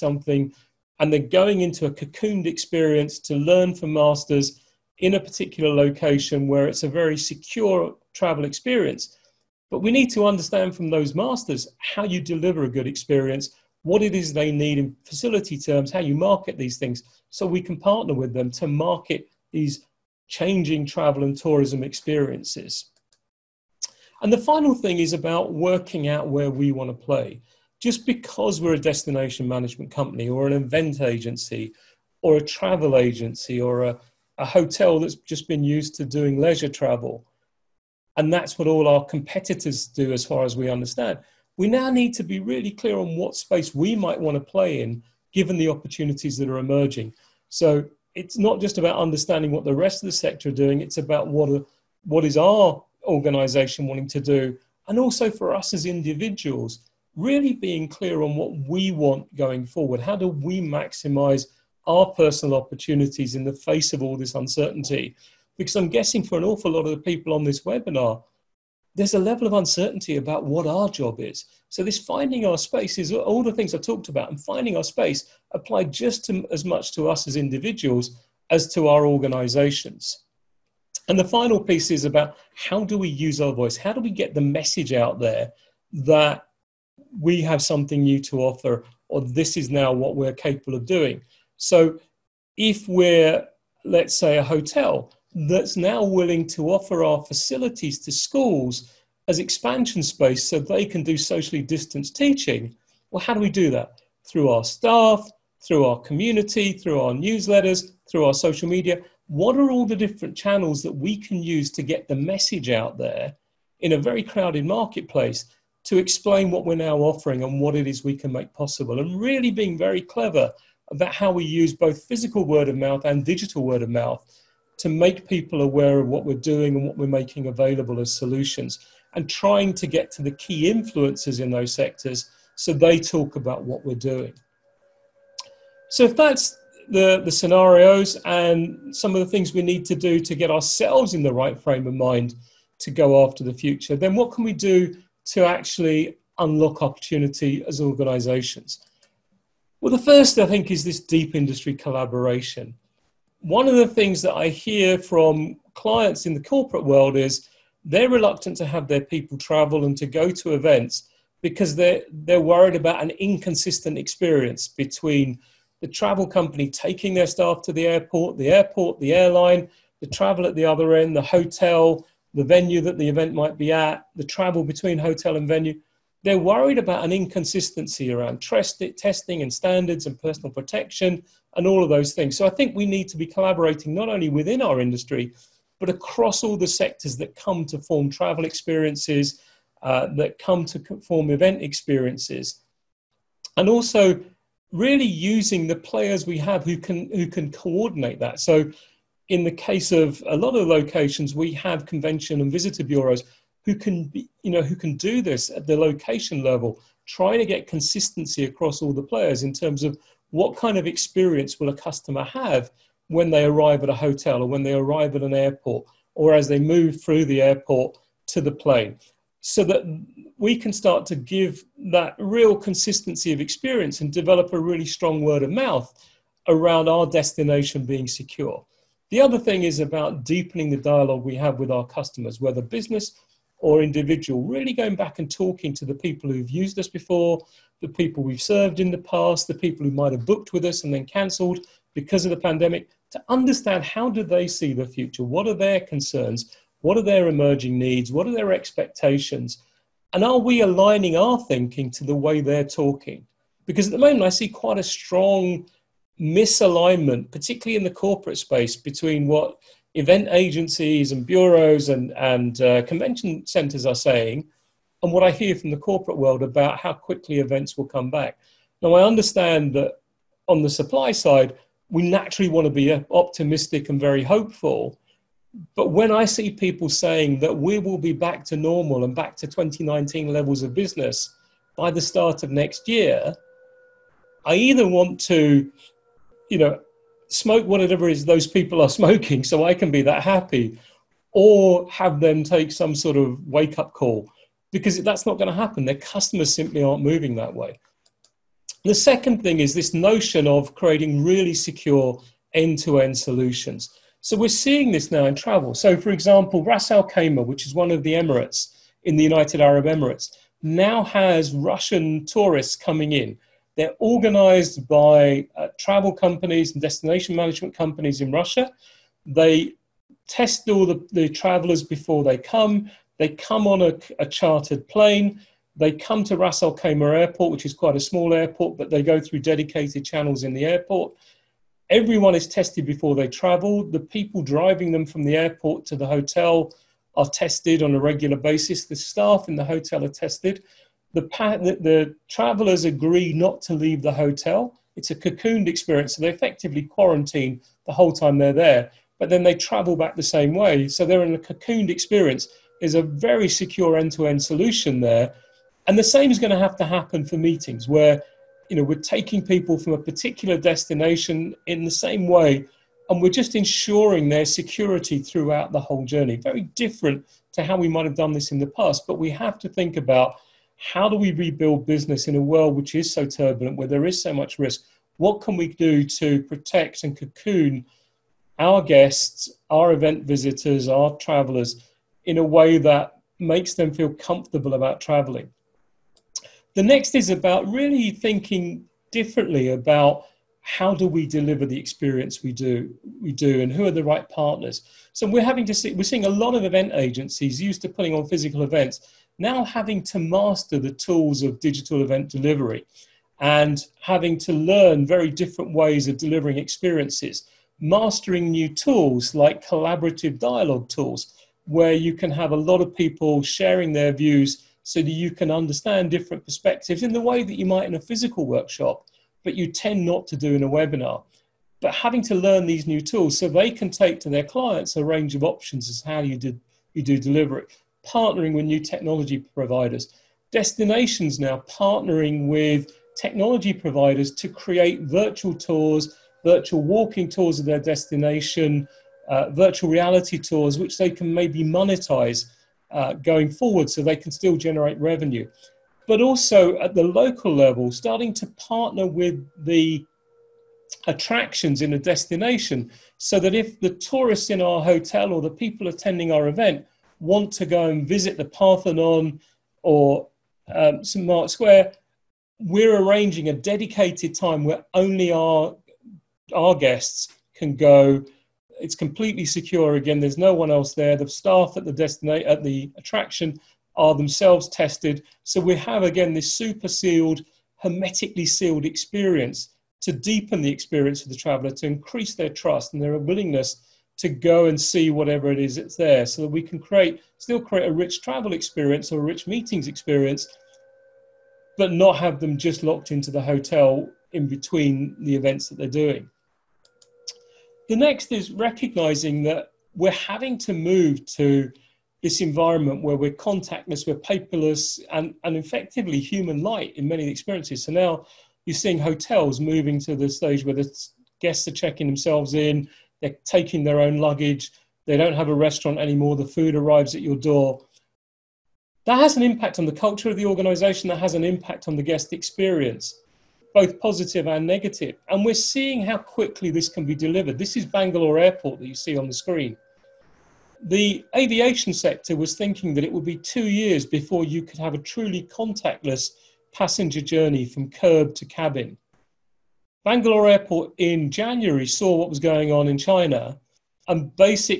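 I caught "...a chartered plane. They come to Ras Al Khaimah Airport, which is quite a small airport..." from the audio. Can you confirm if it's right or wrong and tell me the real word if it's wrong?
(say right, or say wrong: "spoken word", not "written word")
right.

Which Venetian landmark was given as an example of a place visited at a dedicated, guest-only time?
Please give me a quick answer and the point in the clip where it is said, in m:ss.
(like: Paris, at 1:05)
St Mark's Square, at 7:41.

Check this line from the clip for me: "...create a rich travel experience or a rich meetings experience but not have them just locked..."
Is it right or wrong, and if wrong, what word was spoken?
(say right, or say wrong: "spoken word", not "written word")
right.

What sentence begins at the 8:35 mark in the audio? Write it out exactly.
They don't have a restaurant anymore.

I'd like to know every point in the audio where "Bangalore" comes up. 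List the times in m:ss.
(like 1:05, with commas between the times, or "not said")
8:47, 9:00.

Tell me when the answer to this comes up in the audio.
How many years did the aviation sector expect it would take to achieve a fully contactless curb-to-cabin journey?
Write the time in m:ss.
8:53.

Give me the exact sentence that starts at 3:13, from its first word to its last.
And also really using the players we have who can, who can coordinate that.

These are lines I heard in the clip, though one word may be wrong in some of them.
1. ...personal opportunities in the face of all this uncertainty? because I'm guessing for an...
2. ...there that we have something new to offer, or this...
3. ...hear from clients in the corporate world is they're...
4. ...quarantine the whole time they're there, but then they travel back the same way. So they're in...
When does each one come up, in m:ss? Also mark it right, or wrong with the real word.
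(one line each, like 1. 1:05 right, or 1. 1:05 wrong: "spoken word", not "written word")
1. 1:02 right
2. 1:25 right
3. 2:34 right
4. 5:46 right.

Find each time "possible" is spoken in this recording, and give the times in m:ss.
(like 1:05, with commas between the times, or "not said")
1:58.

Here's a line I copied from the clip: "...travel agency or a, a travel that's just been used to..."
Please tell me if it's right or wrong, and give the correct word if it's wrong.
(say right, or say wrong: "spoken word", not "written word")
wrong: "hotel", not "travel".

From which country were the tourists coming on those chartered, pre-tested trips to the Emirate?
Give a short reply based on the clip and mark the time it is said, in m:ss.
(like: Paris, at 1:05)
Russia, at 5:11.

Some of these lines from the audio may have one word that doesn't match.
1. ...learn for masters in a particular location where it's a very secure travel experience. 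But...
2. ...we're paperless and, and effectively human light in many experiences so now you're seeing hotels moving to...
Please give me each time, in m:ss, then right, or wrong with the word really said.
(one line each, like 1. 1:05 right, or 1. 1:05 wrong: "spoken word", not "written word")
1. 0:03 right
2. 8:24 right.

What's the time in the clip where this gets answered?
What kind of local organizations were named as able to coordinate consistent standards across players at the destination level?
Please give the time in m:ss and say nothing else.
3:21.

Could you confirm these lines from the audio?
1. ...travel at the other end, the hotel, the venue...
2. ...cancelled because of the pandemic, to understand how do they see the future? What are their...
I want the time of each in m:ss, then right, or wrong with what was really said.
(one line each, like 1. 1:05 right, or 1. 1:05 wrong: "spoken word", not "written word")
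1. 2:50 right
2. 4:01 right.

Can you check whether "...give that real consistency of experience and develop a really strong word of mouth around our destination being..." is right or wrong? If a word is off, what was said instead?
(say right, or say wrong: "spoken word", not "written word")
right.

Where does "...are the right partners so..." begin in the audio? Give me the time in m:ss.
6:33.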